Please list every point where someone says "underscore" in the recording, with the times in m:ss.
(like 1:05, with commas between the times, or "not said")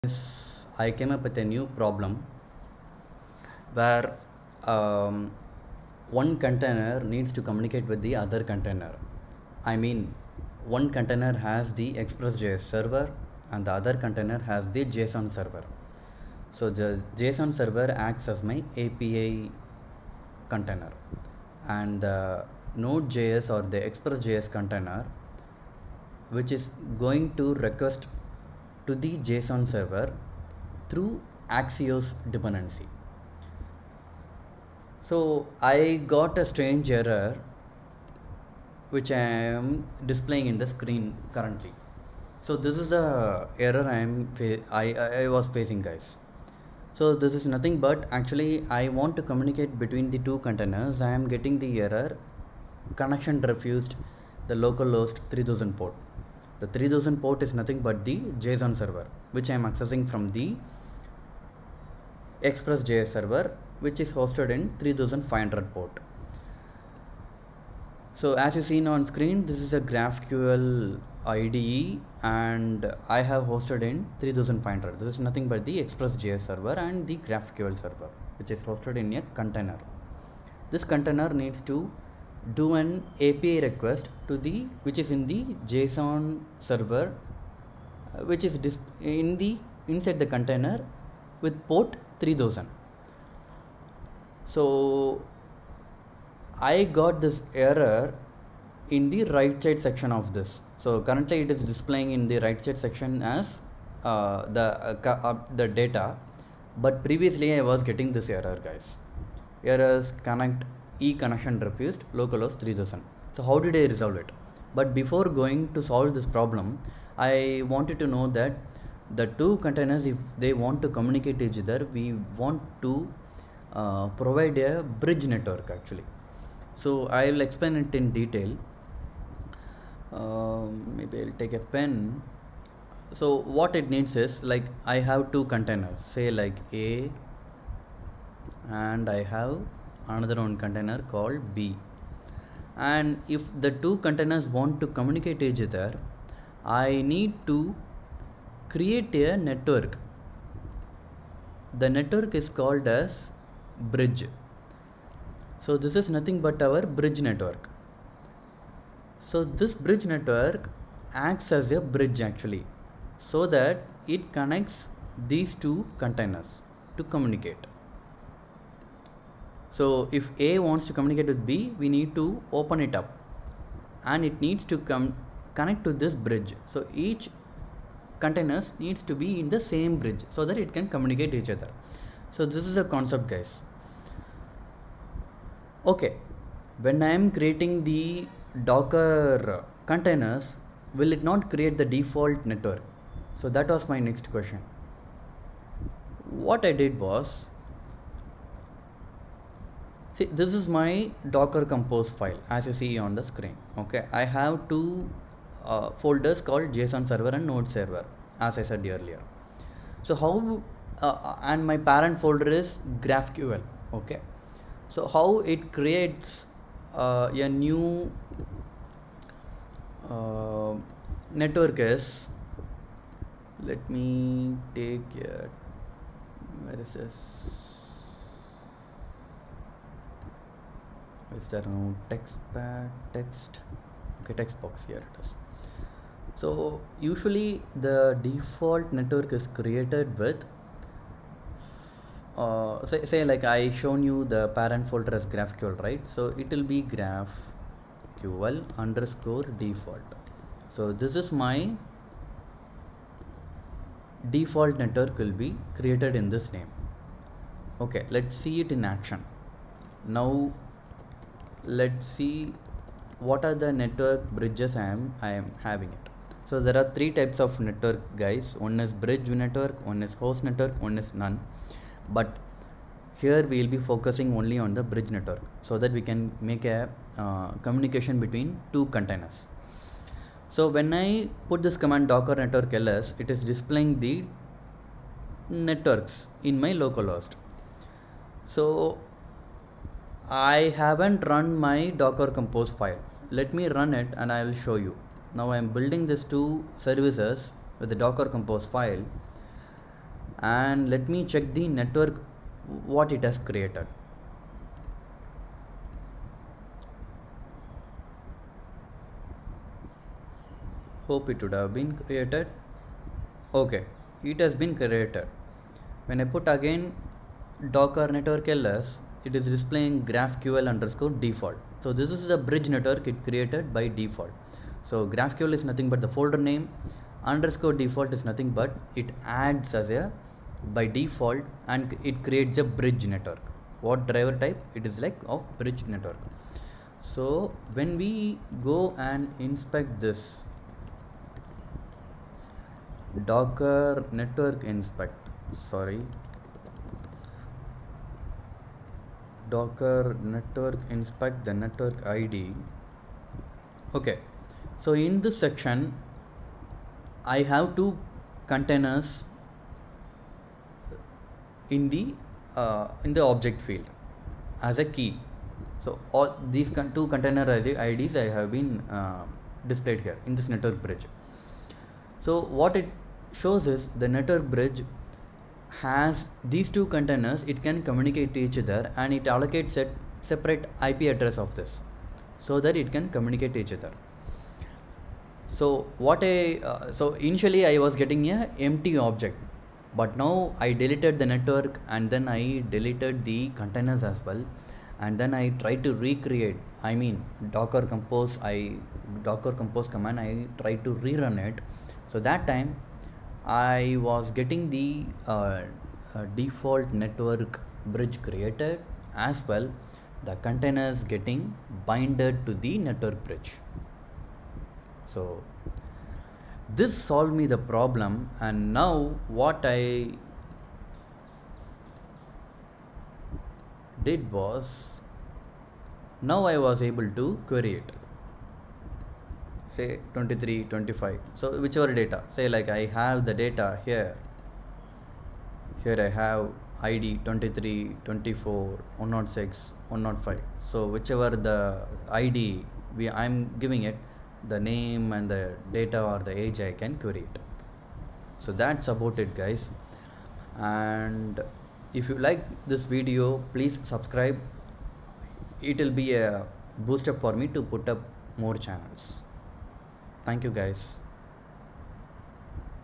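4:08, 5:20, 5:27.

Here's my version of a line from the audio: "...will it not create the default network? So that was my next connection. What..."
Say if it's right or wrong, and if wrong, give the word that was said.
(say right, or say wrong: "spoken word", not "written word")
wrong: "question", not "connection".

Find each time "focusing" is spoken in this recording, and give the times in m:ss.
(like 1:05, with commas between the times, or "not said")
4:33.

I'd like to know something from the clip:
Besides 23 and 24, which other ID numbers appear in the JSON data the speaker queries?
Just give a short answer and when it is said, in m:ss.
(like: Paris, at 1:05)
106 and 105, at 7:19.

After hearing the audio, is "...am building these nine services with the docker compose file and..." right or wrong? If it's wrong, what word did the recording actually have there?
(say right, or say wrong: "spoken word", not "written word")
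wrong: "two", not "nine".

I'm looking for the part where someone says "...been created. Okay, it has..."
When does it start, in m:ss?
5:11.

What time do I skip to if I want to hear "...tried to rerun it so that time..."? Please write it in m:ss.
6:40.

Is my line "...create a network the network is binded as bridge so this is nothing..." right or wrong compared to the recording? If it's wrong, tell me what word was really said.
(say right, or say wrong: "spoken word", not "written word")
wrong: "called", not "binded".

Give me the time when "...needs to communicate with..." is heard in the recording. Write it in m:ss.
0:07.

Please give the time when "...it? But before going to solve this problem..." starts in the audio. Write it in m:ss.
1:54.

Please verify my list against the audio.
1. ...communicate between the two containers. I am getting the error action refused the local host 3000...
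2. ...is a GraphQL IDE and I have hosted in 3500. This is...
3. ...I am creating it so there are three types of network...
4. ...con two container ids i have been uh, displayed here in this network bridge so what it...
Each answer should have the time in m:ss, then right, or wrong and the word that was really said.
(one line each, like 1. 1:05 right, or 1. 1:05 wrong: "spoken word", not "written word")
1. 0:49 wrong: "connection", not "action"
2. 1:09 right
3. 4:25 wrong: "having", not "creating"
4. 6:06 right.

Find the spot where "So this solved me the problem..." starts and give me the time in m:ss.
6:55.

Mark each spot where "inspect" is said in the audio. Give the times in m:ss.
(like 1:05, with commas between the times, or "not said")
5:39, 5:44, 5:50.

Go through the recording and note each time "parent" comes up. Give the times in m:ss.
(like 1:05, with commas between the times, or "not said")
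3:31, 4:04.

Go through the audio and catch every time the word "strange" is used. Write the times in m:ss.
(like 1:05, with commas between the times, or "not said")
0:36.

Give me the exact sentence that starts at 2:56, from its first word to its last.
So each containers needs to be in the same bridge so that it can communicate each other.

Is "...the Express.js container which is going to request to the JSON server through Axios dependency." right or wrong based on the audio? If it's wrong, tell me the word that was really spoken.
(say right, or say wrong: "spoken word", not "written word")
right.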